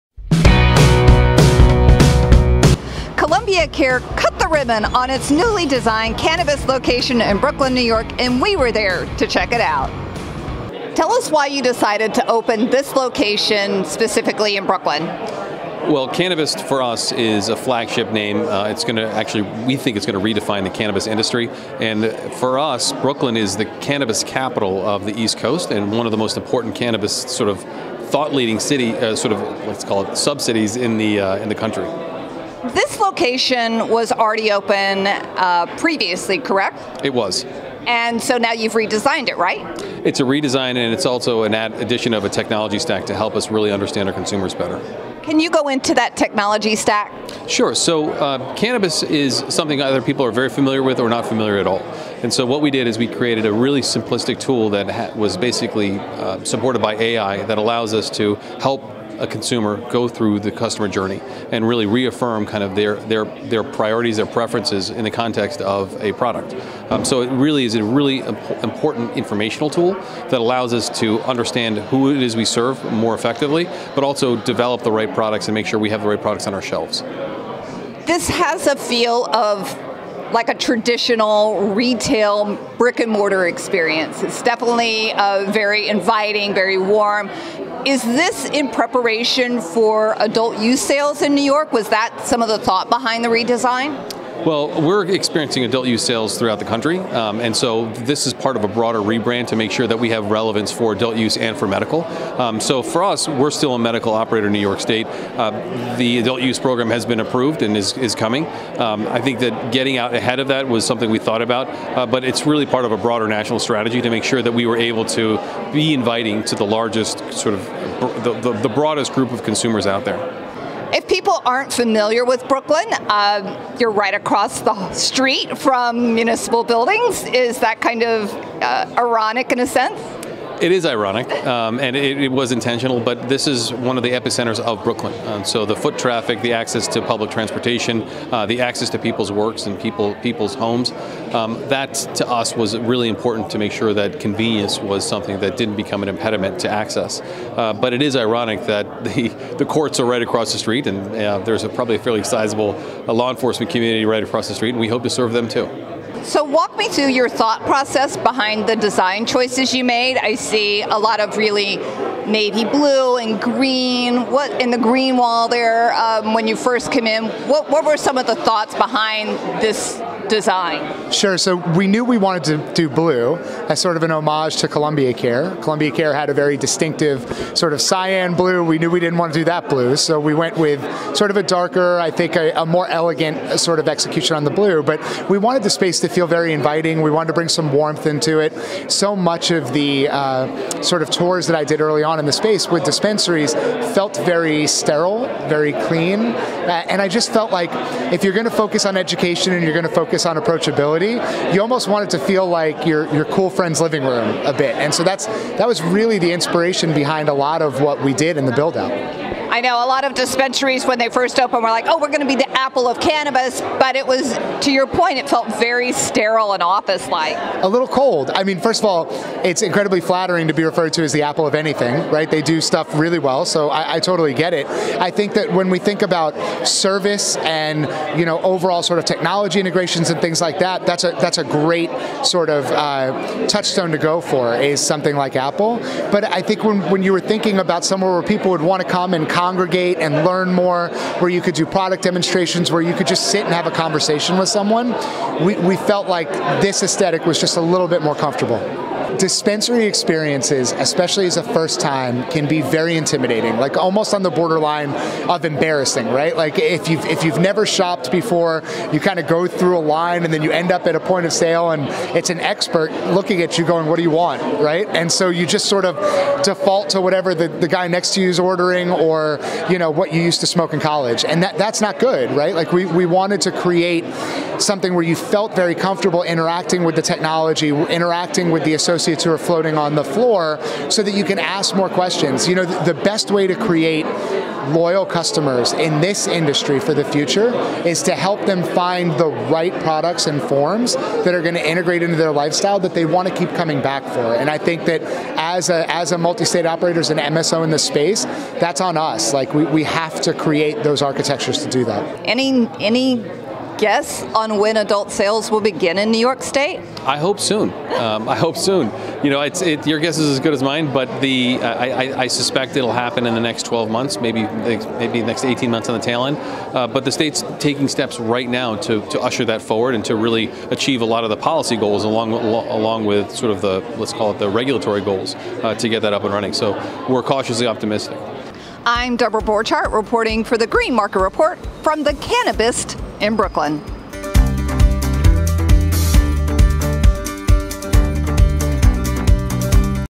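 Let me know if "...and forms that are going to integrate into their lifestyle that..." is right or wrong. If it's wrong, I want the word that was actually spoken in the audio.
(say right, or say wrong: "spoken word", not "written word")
right.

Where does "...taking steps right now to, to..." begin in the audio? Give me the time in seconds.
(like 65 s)
317 s.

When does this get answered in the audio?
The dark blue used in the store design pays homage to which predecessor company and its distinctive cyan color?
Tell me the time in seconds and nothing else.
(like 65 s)
174 s.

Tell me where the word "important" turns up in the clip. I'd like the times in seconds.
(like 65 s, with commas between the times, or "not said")
26 s, 68 s, 143 s.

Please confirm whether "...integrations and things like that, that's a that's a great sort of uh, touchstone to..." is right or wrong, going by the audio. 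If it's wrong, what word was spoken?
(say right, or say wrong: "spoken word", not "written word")
right.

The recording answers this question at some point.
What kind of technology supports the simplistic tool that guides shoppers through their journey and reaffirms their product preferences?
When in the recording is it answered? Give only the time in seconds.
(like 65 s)
56 s.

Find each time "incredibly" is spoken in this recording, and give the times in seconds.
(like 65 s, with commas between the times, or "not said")
219 s.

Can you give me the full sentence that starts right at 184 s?
But we wanted the space to feel very inviting.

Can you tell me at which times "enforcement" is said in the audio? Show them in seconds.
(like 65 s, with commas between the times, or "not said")
153 s.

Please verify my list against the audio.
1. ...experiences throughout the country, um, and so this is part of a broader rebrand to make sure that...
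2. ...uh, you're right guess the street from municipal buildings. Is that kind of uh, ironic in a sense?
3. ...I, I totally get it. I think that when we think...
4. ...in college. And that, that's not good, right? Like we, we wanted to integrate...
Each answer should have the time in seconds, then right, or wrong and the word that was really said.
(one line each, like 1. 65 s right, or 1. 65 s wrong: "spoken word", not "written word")
1. 96 s wrong: "sales", not "experiences"
2. 122 s wrong: "across", not "guess"
3. 223 s right
4. 270 s wrong: "create", not "integrate".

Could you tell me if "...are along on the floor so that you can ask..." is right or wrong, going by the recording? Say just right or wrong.
wrong.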